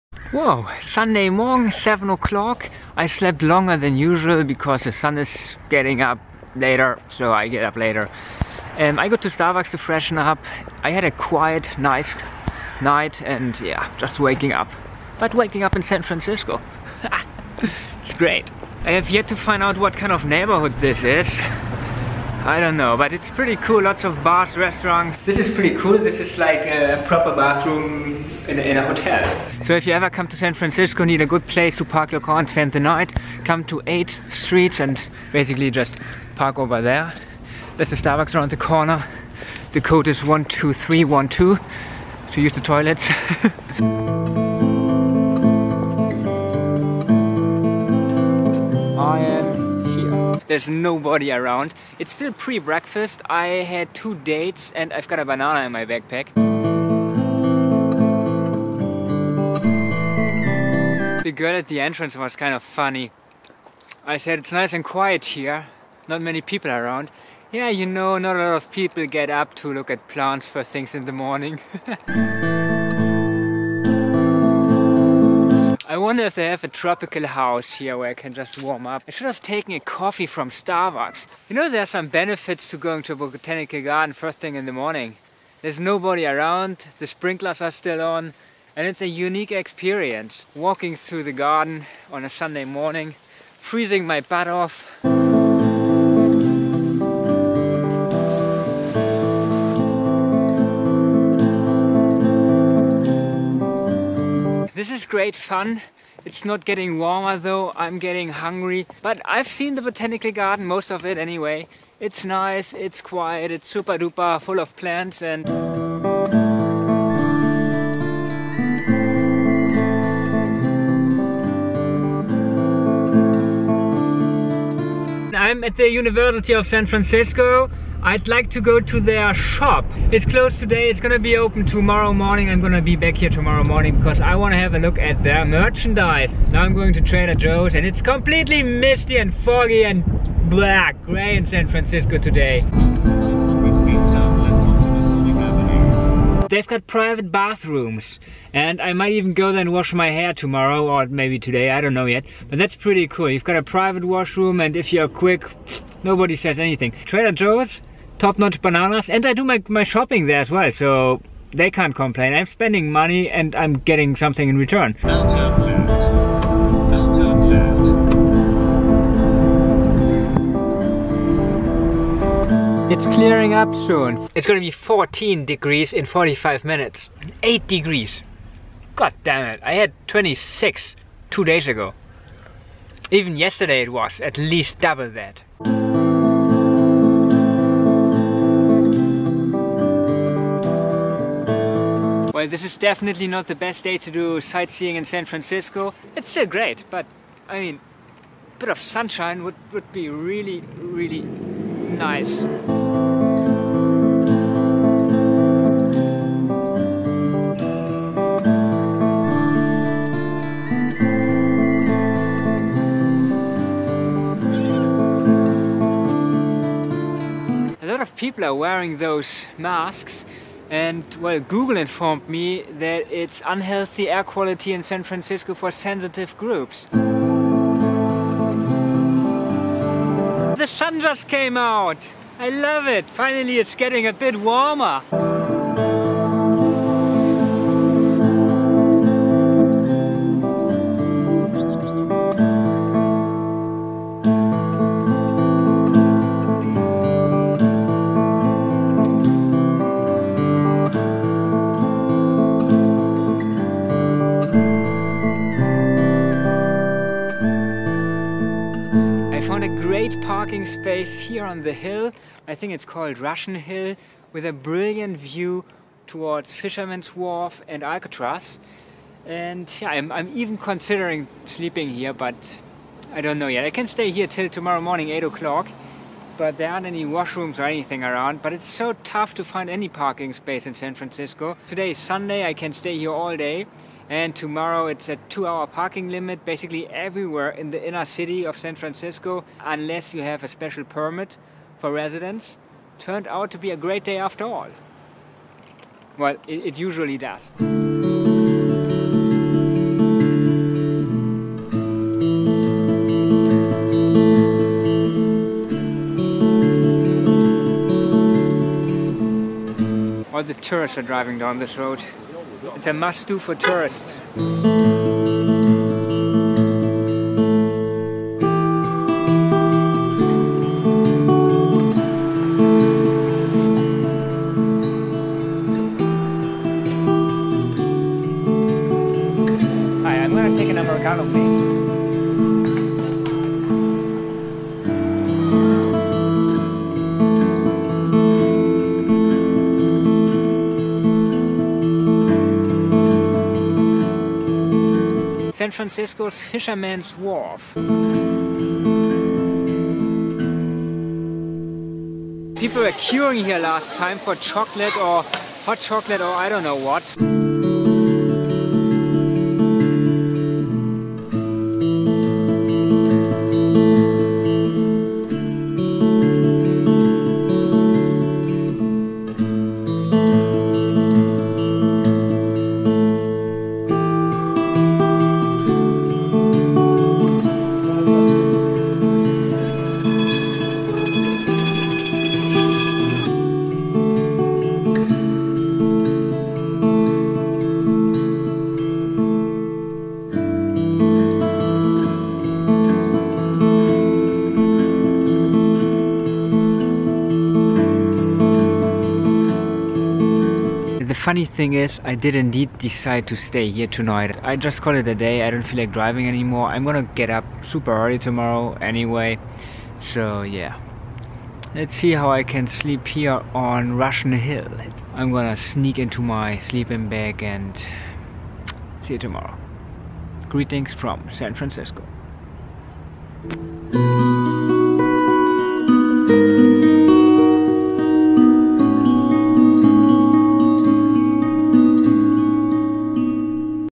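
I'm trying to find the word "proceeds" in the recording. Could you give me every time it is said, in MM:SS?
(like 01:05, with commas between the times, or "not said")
not said.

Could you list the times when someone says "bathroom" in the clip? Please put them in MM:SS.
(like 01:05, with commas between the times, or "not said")
00:27, 02:27.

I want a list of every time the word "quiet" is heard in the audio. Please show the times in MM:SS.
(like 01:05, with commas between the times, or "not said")
00:11, 01:04, 01:52.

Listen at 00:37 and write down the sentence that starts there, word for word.
There's a Starbucks around the corner.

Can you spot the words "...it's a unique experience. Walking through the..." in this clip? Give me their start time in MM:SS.
01:28.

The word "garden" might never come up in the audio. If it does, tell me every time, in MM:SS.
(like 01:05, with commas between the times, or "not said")
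01:23, 01:31, 01:50.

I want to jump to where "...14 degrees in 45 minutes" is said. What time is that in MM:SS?
02:54.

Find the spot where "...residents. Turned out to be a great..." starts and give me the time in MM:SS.
04:51.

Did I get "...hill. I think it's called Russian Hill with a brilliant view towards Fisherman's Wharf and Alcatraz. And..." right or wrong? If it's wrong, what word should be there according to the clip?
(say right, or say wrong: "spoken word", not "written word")
right.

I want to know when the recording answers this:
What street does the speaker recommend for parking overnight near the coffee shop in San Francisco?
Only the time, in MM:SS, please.
00:33.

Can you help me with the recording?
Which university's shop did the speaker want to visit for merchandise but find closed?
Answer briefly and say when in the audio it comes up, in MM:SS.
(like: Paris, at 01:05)
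University of San Francisco, at 02:05.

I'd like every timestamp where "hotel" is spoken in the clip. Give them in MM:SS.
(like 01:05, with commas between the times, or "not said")
00:28.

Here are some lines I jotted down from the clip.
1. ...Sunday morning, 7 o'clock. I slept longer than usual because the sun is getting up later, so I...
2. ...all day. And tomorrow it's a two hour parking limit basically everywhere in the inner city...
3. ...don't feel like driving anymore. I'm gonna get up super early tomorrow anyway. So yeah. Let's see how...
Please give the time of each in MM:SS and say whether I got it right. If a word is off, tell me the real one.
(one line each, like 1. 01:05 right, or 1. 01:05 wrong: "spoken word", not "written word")
1. 00:00 right
2. 04:43 right
3. 06:45 right.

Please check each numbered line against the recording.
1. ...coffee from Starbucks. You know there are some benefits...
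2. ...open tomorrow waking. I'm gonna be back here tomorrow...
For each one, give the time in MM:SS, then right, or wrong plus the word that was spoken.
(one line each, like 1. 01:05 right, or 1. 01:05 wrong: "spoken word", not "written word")
1. 01:19 right
2. 02:11 wrong: "morning", not "waking".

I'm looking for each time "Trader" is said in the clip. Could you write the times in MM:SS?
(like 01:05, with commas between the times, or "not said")
02:17, 02:37.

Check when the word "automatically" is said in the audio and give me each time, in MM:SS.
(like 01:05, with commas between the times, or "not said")
not said.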